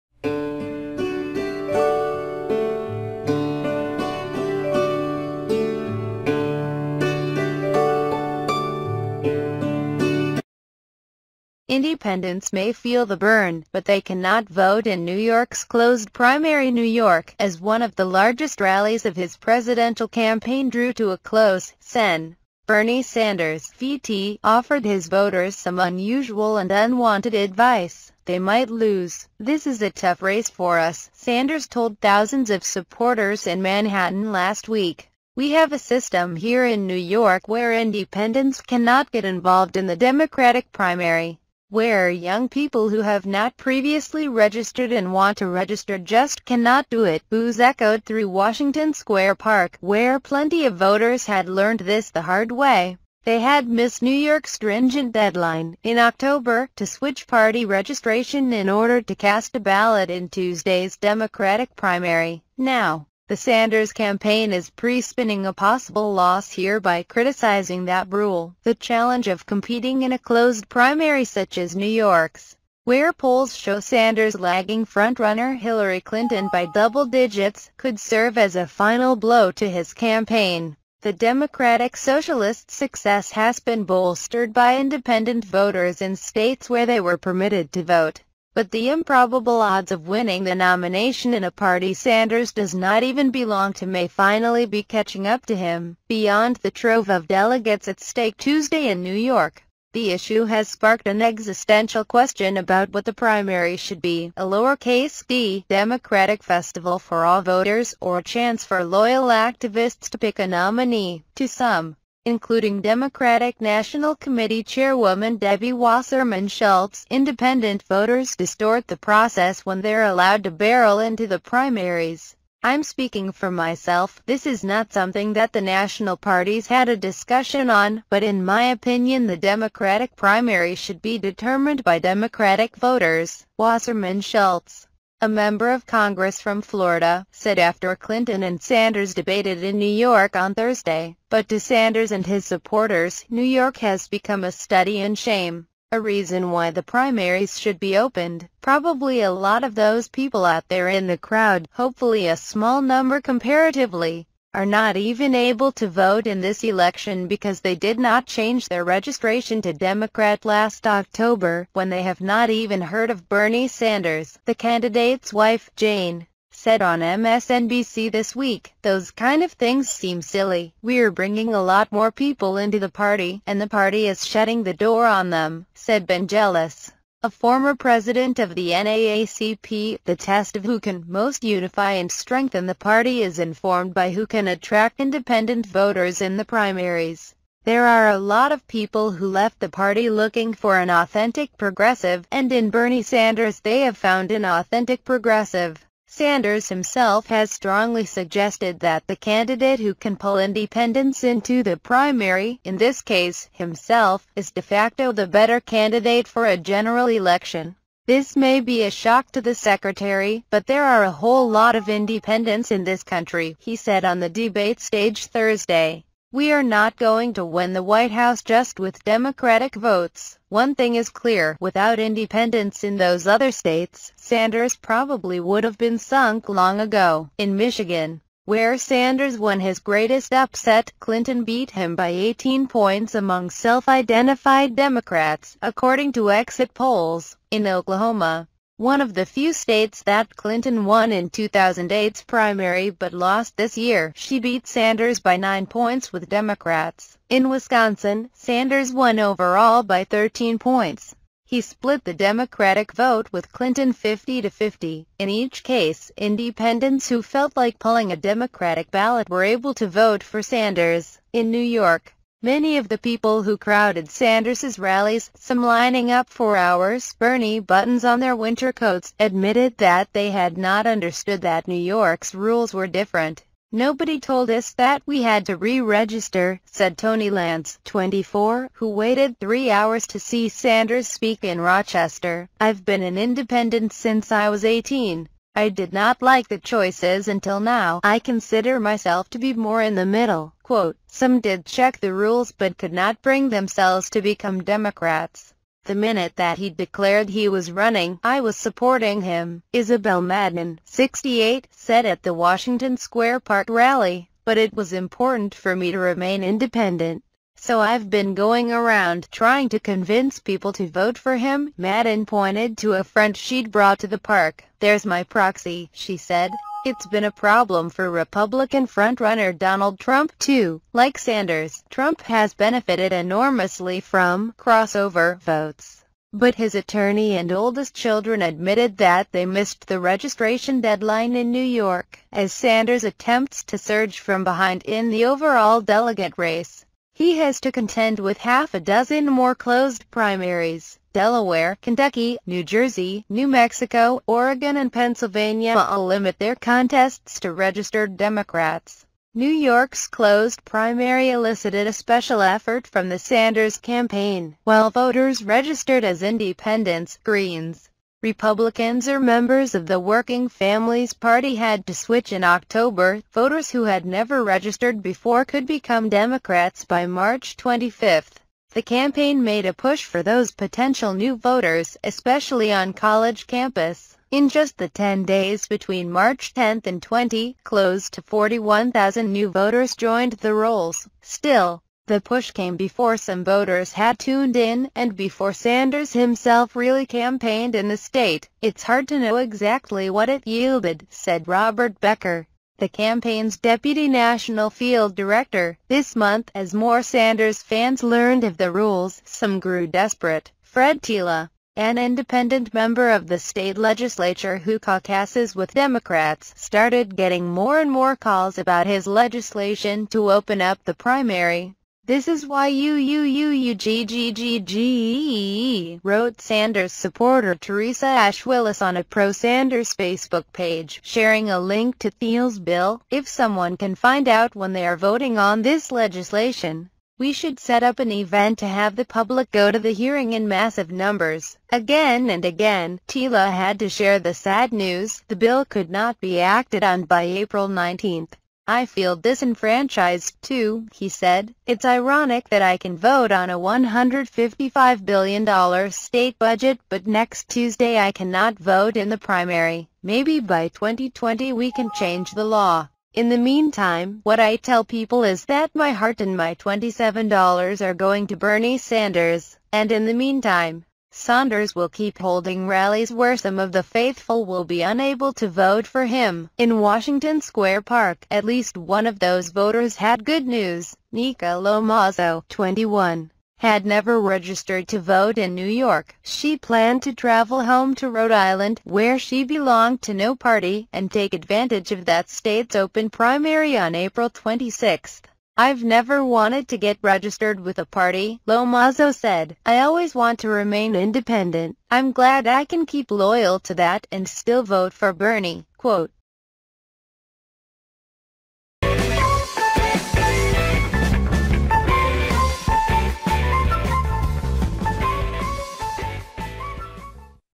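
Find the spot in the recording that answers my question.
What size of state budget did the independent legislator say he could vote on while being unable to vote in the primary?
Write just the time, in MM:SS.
07:23.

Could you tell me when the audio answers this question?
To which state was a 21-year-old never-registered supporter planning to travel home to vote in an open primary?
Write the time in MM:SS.
07:58.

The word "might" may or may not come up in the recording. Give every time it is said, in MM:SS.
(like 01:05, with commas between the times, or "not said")
00:28.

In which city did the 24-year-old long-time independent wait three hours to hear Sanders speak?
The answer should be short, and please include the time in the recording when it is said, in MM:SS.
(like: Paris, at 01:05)
Rochester, at 04:41.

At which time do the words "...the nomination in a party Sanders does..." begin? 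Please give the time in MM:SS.
01:30.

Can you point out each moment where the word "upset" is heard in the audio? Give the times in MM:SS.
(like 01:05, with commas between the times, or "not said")
03:50.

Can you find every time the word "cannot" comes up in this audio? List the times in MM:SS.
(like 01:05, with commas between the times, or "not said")
00:14, 00:38, 00:46, 07:28.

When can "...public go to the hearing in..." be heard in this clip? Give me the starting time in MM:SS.
07:09.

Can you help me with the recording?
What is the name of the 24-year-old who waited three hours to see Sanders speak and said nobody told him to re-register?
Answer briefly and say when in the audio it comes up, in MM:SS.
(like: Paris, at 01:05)
Tony Lance, at 04:36.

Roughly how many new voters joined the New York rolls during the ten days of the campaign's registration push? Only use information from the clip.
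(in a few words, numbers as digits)
41,000.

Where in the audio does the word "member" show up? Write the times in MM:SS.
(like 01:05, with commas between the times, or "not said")
02:15, 05:59, 06:42.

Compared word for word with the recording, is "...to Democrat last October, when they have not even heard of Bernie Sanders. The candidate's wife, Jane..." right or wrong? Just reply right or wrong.
right.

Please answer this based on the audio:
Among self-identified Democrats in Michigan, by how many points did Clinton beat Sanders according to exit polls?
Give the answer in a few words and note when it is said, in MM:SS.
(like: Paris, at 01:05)
18 points, at 03:52.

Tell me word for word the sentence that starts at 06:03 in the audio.
Voters who had never registered before could become Democrats by March 25.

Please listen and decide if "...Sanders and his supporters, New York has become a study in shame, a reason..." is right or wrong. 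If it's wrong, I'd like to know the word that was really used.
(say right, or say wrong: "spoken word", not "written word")
right.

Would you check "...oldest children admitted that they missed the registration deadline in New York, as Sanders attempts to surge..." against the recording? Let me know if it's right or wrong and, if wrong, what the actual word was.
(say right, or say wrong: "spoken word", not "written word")
right.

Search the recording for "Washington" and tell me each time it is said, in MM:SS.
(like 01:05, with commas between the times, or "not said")
00:48, 05:02, 07:46.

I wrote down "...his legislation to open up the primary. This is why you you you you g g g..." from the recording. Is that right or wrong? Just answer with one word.
right.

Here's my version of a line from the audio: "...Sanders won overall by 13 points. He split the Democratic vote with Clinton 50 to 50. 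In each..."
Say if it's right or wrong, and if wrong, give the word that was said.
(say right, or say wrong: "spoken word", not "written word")
right.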